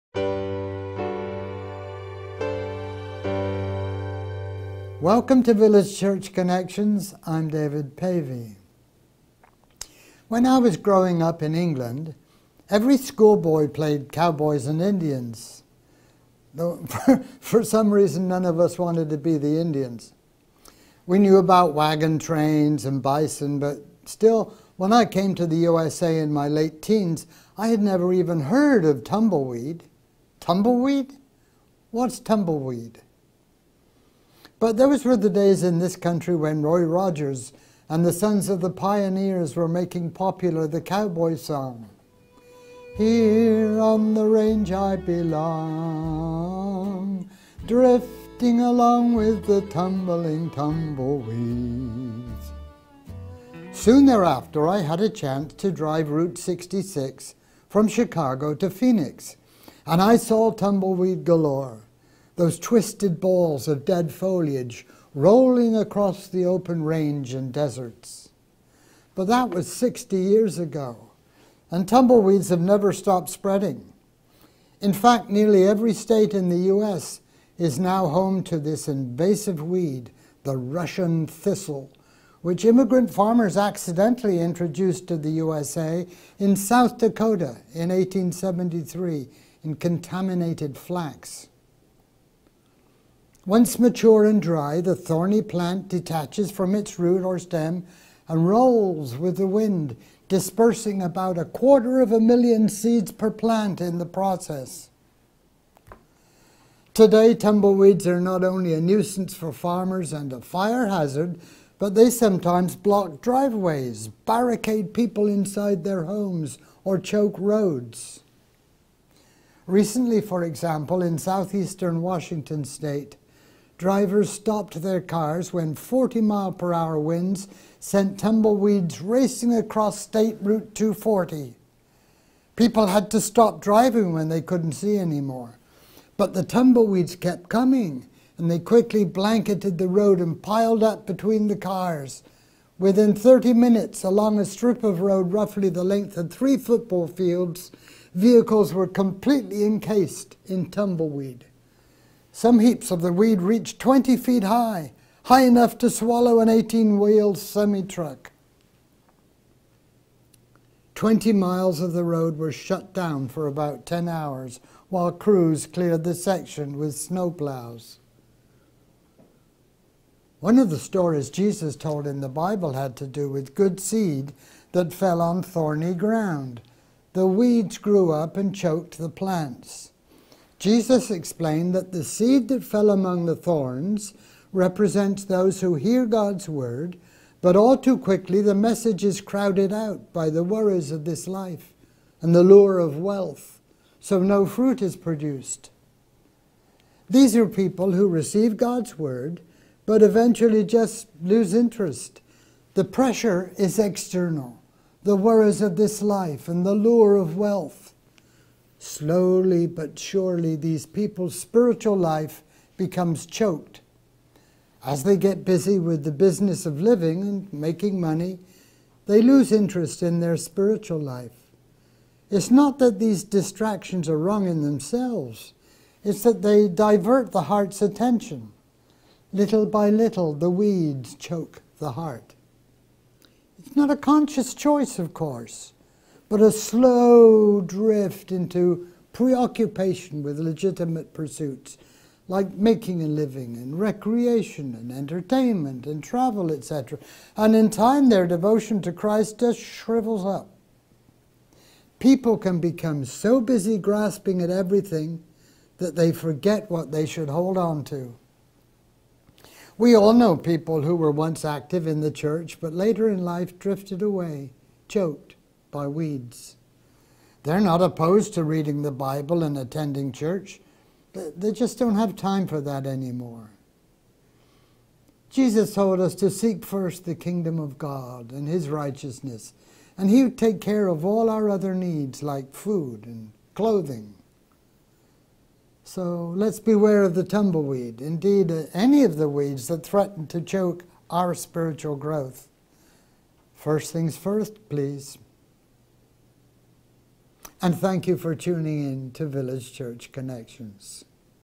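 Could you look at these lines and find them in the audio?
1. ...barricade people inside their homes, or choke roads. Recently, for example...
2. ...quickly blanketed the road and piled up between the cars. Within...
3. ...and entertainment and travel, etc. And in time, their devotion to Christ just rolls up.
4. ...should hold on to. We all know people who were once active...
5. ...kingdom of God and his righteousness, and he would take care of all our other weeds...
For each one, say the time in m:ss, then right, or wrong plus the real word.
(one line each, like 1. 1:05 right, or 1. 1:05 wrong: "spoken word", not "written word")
1. 1:54 right
2. 2:18 right
3. 4:04 wrong: "shrivels", not "rolls"
4. 4:17 right
5. 4:37 wrong: "needs", not "weeds".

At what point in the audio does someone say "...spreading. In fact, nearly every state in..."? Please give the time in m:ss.
1:13.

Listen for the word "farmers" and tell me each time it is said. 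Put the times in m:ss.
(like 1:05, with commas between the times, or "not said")
1:23, 1:49.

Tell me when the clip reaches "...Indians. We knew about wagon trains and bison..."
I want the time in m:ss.
0:19.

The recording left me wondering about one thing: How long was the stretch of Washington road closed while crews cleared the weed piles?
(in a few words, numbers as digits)
10 hours.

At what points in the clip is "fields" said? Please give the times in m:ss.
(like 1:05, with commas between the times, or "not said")
2:27.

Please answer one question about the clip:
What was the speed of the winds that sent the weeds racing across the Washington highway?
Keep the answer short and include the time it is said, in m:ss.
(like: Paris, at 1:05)
40 mph, at 2:05.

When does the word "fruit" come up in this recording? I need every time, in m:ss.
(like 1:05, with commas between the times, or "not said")
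3:14.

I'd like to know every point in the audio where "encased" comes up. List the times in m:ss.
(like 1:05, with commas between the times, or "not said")
2:29.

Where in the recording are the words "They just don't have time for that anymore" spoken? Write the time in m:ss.
4:31.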